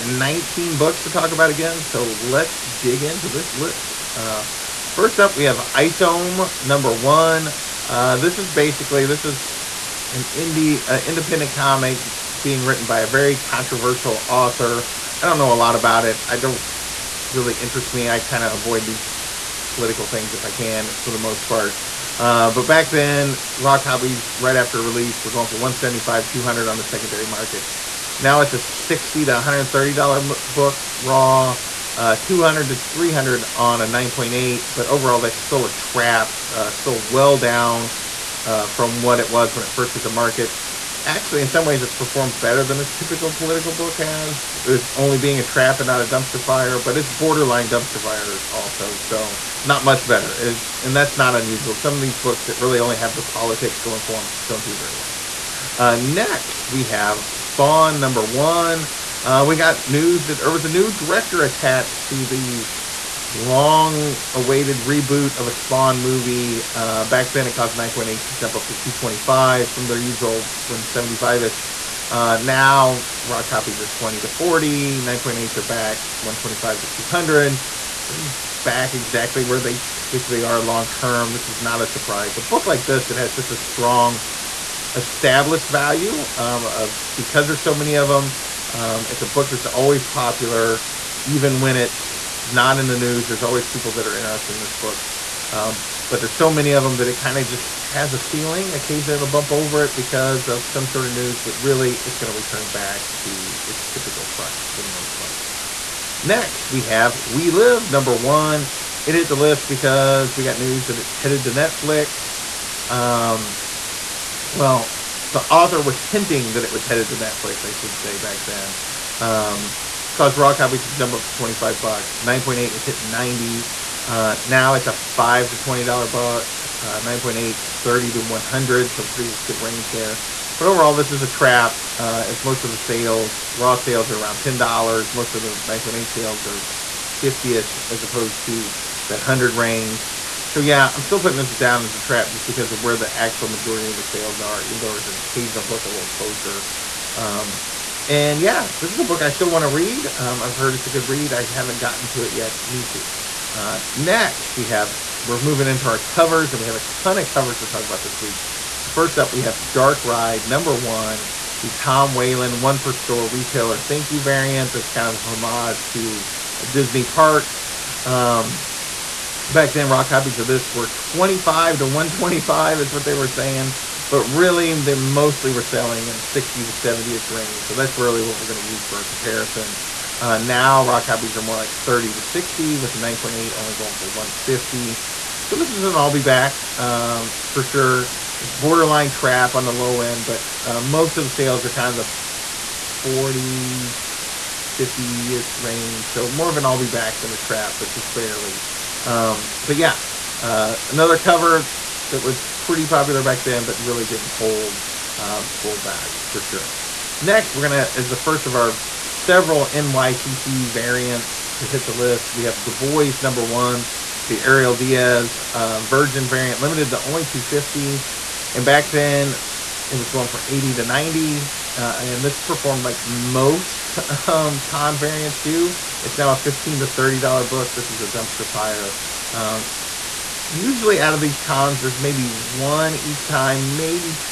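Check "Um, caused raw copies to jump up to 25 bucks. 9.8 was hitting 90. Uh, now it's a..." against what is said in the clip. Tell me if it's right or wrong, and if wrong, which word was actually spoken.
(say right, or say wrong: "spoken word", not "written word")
right.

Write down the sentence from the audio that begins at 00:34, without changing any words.
But overall, that's still a trap.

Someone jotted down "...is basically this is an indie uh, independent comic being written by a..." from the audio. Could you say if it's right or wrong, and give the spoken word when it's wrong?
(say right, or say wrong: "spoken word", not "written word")
right.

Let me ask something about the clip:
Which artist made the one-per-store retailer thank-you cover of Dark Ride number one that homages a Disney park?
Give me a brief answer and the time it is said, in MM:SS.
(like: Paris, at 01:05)
Tom Whalen, at 02:41.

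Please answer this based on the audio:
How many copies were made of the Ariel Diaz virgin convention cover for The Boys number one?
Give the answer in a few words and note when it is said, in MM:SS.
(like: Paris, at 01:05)
250, at 03:37.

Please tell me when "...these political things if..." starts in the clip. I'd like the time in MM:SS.
00:18.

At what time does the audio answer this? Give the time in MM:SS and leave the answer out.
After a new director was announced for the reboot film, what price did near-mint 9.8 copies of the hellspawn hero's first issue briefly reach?
01:08.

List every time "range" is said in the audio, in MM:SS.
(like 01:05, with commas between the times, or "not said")
02:09, 02:19, 02:57, 03:15.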